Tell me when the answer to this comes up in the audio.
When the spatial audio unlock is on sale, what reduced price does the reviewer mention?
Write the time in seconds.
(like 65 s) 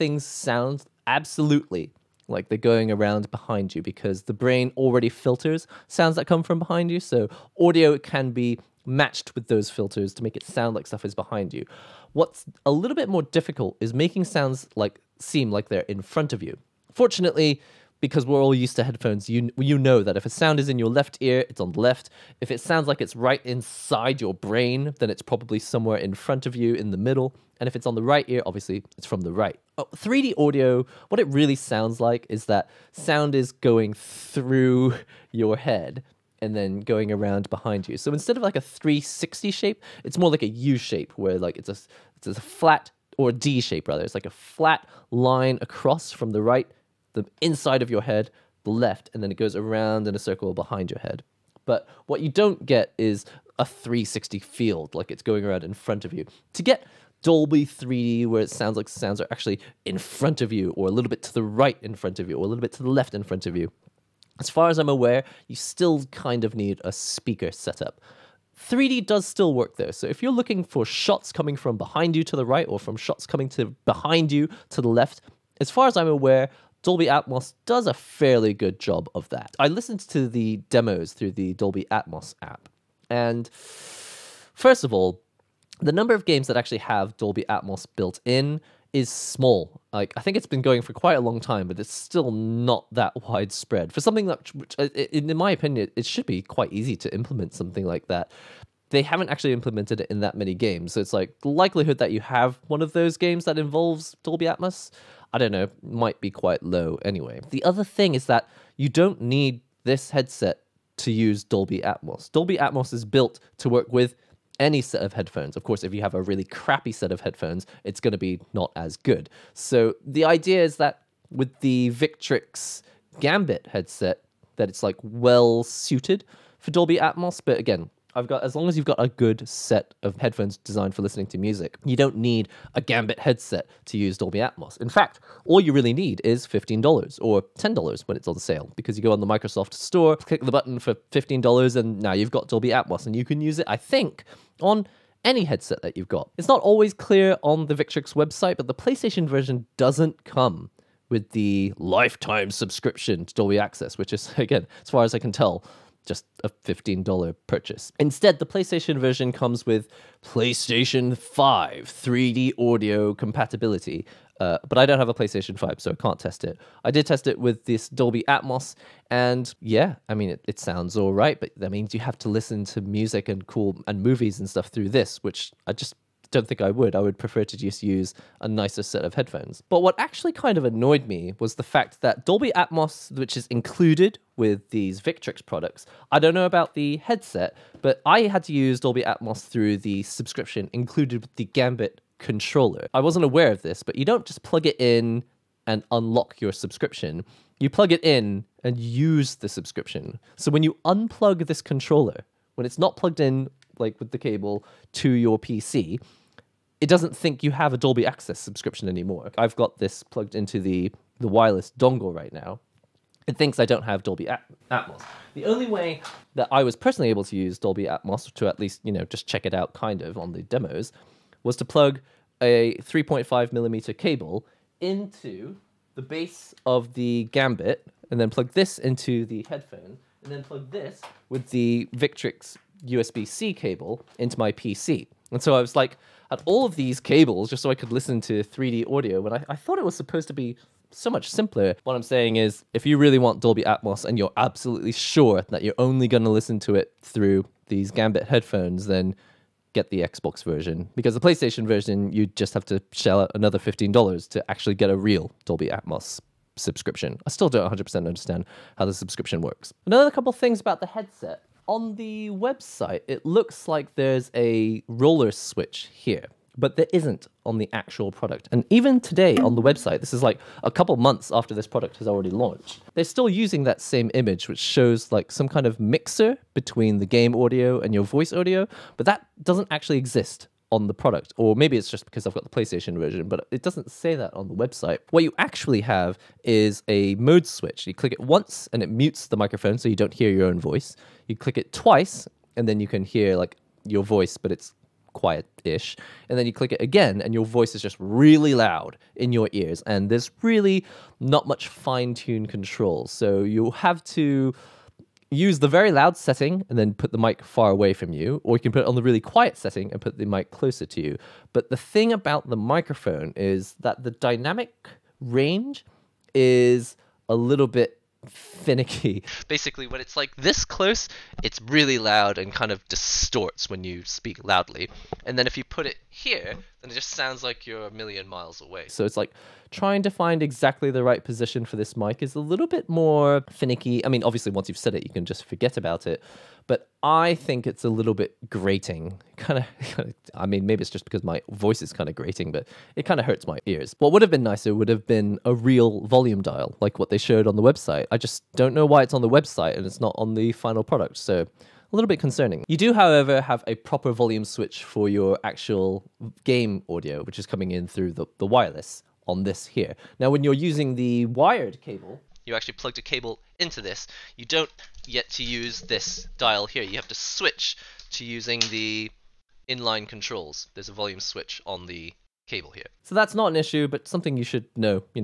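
137 s.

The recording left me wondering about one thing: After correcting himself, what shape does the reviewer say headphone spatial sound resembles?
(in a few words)
D shape.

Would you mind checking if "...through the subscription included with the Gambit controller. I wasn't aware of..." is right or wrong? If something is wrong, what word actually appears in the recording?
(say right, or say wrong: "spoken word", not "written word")
right.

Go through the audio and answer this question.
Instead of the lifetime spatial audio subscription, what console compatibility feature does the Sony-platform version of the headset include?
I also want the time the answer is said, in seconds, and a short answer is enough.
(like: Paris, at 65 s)
PlayStation 5 3D audio, at 160 s.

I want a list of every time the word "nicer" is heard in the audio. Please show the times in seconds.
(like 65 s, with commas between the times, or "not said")
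178 s, 344 s.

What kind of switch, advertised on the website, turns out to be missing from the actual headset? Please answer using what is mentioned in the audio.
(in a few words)
roller switch.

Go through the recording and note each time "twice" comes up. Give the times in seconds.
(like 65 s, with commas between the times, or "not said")
291 s.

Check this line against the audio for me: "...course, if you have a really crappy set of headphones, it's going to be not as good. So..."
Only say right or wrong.
right.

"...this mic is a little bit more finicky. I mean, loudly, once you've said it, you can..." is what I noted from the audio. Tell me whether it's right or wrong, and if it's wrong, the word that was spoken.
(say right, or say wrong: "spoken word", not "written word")
wrong: "obviously", not "loudly".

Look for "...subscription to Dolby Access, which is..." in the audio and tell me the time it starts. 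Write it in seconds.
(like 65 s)
152 s.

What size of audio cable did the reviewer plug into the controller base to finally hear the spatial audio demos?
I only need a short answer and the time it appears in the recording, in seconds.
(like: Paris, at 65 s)
3.5 millimeter, at 222 s.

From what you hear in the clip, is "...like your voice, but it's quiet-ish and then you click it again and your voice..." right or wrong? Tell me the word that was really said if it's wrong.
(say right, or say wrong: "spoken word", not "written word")
right.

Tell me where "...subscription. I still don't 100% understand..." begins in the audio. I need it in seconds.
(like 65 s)
256 s.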